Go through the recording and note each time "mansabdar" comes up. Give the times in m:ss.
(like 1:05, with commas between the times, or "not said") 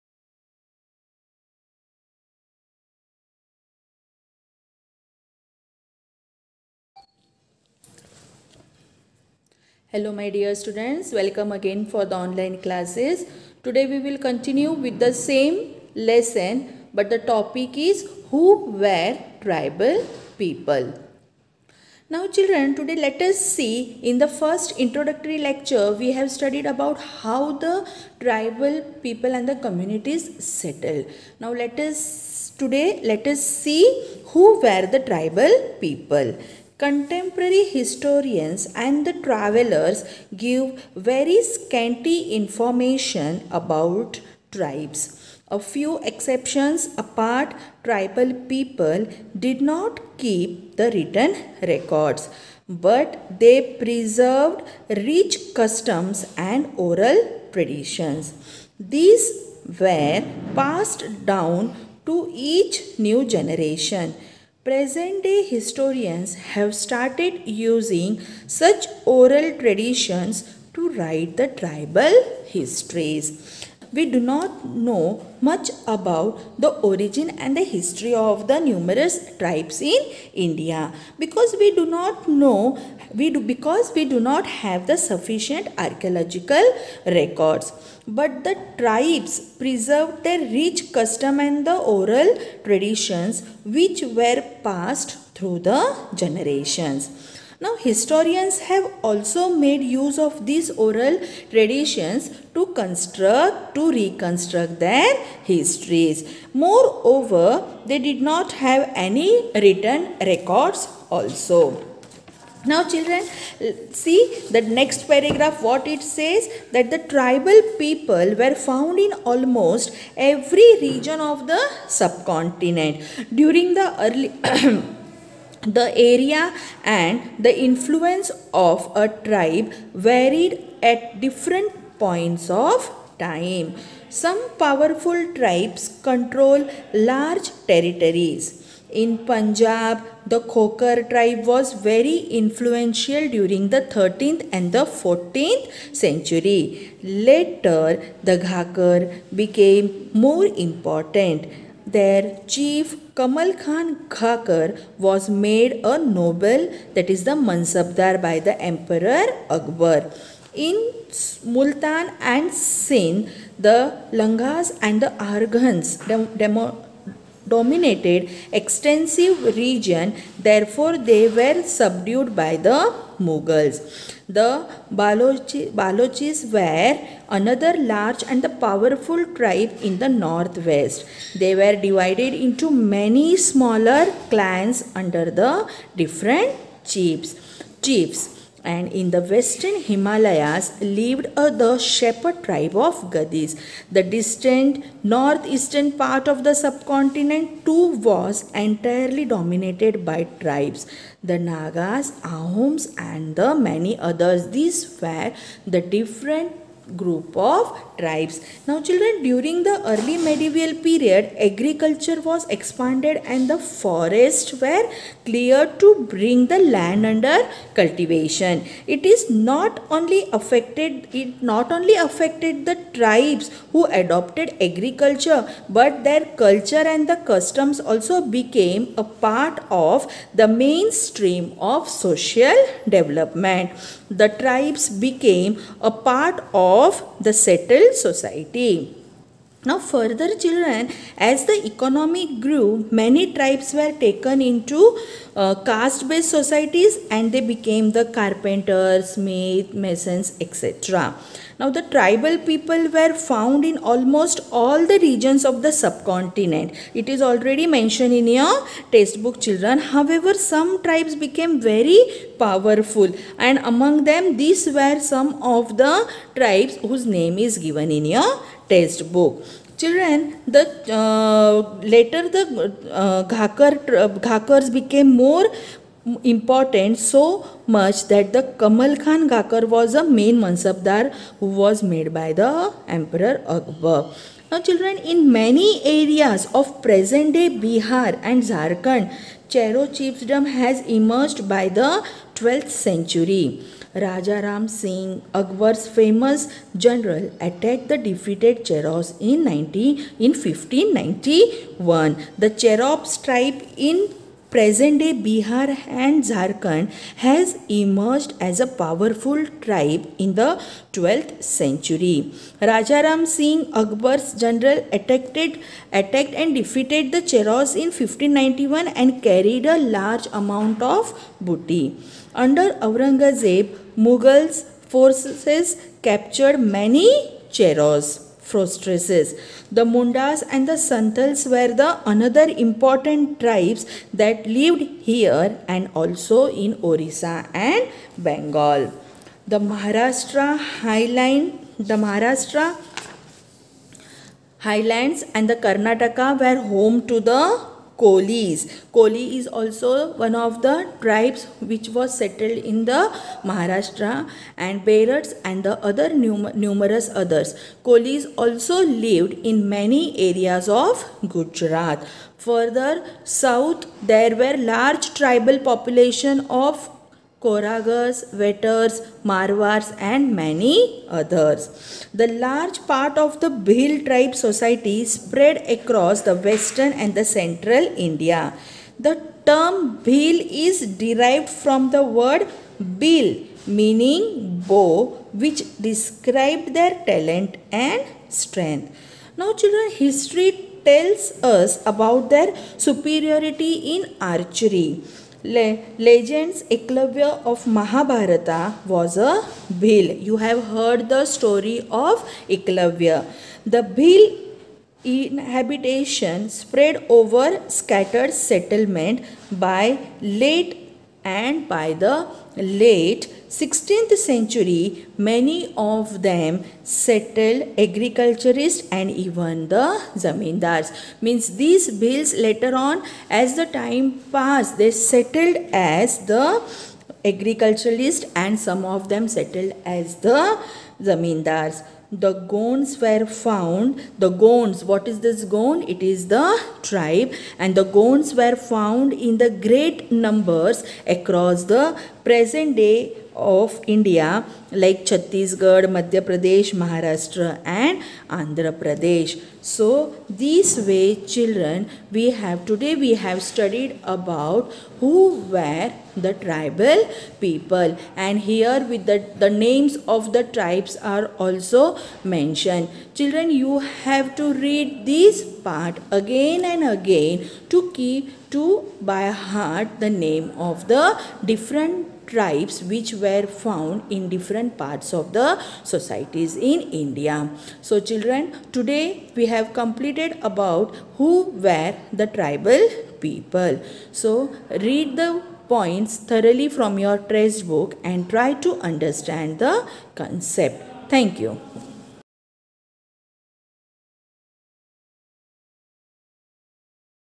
2:37, 4:40.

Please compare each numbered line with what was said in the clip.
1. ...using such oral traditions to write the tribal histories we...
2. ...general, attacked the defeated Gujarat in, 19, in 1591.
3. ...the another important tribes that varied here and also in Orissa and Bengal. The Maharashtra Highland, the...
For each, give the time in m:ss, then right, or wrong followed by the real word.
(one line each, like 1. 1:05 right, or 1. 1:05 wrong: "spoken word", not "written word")
1. 1:07 right
2. 4:56 wrong: "Cheros", not "Gujarat"
3. 5:31 wrong: "lived", not "varied".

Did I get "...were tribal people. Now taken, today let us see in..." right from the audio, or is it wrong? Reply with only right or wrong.
wrong.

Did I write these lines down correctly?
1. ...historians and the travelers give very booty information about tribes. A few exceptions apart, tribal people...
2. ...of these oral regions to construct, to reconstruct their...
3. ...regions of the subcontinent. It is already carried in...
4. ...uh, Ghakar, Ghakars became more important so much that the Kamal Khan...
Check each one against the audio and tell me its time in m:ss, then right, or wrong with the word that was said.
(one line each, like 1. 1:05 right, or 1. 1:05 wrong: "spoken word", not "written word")
1. 0:37 wrong: "scanty", not "booty"
2. 1:40 wrong: "traditions", not "regions"
3. 4:14 wrong: "mentioned", not "carried"
4. 4:32 right.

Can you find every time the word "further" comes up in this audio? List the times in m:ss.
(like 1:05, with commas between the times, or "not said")
3:59, 6:02.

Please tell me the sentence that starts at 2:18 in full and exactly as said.
In Punjab, the Khokhar tribe was very influential during the 13th and the 14th century.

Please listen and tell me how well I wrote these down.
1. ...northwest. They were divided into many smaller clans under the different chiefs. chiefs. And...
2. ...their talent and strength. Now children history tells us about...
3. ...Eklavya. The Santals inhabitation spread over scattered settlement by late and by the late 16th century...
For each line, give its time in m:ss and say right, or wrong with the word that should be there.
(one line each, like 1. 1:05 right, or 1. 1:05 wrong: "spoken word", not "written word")
1. 3:00 right
2. 6:26 right
3. 6:42 wrong: "Bhil", not "Santals".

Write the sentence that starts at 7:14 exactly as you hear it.
The Gonds, what is this Gond?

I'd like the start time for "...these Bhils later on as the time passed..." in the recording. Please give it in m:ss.
7:01.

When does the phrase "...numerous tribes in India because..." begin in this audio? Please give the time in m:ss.
1:18.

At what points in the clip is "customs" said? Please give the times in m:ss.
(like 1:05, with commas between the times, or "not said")
0:55, 1:30, 3:47.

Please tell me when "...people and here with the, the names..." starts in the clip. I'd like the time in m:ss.
7:37.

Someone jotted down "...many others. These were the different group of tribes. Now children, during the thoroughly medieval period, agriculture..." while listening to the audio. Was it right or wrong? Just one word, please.
wrong.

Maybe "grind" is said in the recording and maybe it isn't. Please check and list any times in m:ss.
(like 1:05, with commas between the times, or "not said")
not said.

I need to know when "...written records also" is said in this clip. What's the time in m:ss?
1:49.